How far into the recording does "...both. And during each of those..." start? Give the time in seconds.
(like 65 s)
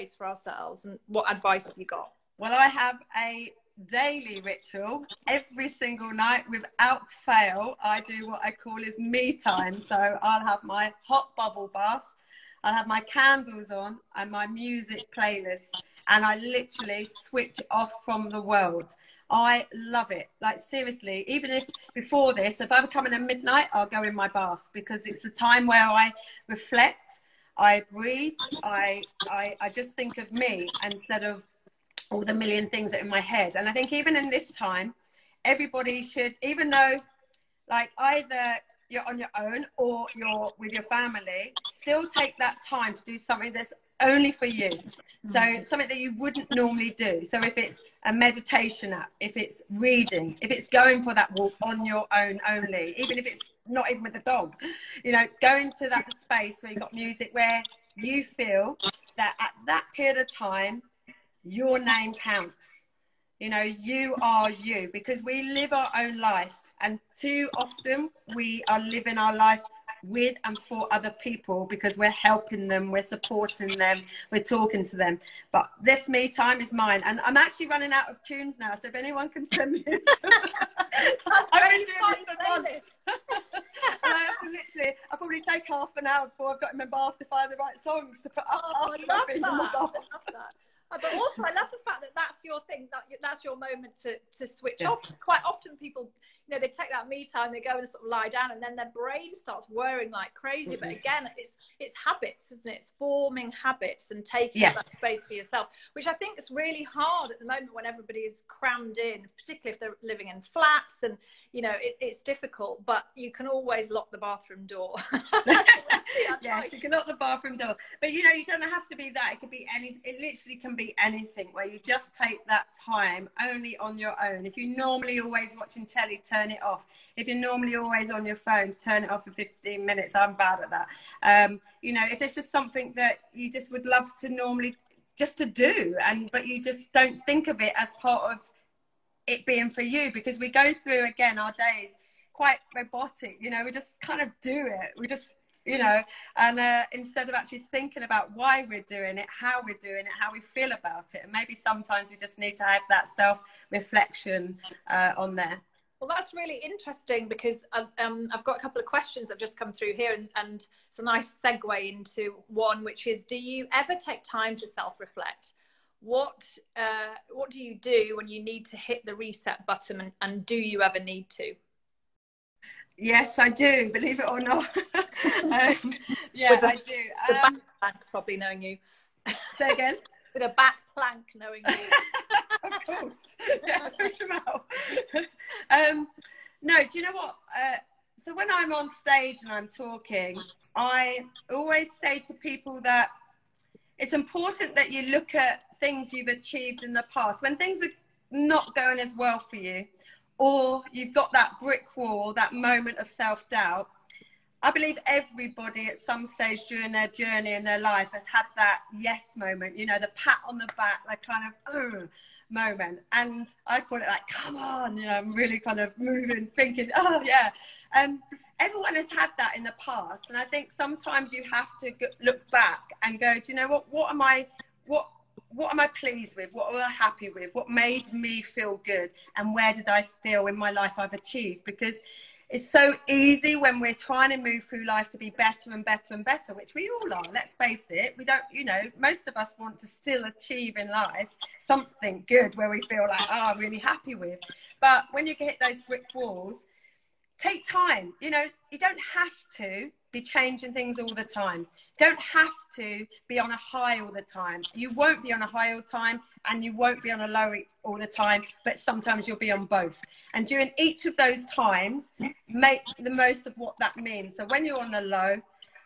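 259 s.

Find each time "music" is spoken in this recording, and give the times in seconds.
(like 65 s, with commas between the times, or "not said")
14 s, 56 s.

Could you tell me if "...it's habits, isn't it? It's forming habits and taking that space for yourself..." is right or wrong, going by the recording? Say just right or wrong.
right.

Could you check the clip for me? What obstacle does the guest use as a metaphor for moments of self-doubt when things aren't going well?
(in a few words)
Brick wall.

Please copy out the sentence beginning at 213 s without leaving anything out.
And I call it like, come on, you know, I'm really kind of moving, thinking, oh yeah.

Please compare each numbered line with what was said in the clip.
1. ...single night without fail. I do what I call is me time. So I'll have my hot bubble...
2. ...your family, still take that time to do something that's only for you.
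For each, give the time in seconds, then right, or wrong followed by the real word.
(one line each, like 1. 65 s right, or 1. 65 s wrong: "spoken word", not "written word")
1. 5 s right
2. 40 s right.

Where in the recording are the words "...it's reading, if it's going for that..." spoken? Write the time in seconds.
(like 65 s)
49 s.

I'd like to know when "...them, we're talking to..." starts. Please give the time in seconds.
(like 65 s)
73 s.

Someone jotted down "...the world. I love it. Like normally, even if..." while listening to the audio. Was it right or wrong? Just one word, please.
wrong.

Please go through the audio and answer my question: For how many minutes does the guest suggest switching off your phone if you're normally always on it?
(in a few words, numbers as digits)
15.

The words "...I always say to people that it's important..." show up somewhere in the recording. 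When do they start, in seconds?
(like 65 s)
190 s.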